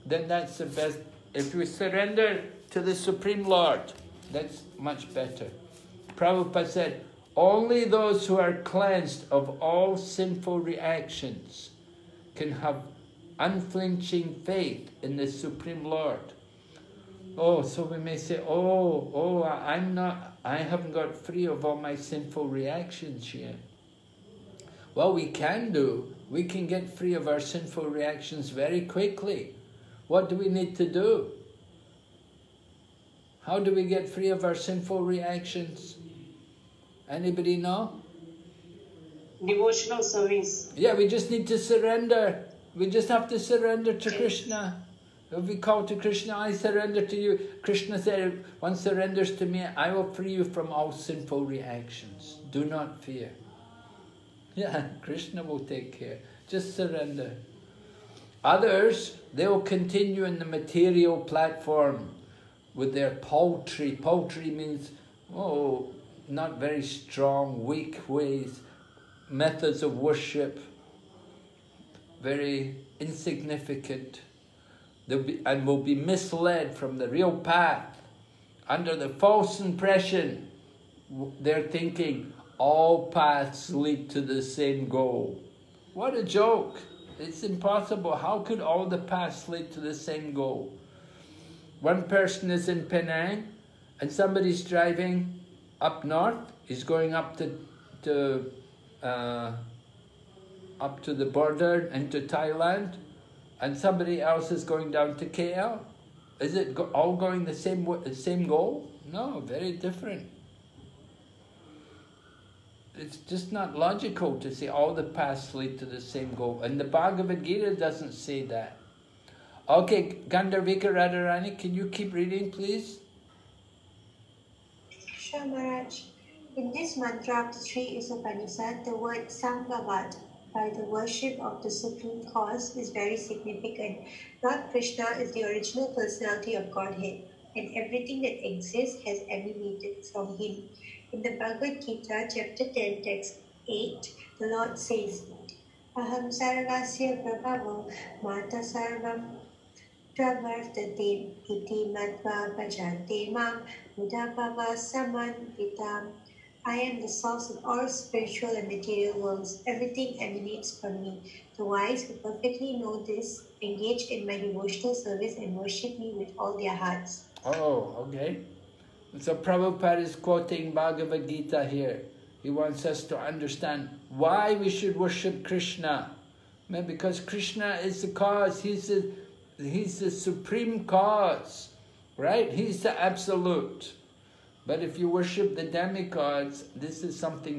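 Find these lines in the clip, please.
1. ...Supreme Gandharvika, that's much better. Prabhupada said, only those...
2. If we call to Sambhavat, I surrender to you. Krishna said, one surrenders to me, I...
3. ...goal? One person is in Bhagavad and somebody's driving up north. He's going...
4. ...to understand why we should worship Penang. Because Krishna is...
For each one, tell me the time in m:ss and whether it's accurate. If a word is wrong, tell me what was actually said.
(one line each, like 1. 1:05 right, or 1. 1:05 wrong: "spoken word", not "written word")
1. 0:02 wrong: "Lord", not "Gandharvika"
2. 0:45 wrong: "Krishna", not "Sambhavat"
3. 1:30 wrong: "Penang", not "Bhagavad"
4. 2:53 wrong: "Krishna", not "Penang".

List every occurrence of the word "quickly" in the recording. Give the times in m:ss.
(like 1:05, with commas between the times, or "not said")
0:28.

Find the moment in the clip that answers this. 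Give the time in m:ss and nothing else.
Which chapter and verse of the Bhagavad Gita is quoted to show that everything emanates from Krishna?
2:22.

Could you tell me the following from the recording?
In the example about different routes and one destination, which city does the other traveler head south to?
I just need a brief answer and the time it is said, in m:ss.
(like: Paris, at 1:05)
KL, at 1:45.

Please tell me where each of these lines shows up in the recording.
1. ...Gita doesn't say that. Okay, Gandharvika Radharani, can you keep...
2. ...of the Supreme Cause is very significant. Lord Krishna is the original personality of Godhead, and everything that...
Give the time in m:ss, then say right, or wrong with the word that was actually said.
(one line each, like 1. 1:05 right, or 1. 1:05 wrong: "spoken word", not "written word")
1. 1:57 right
2. 2:11 right.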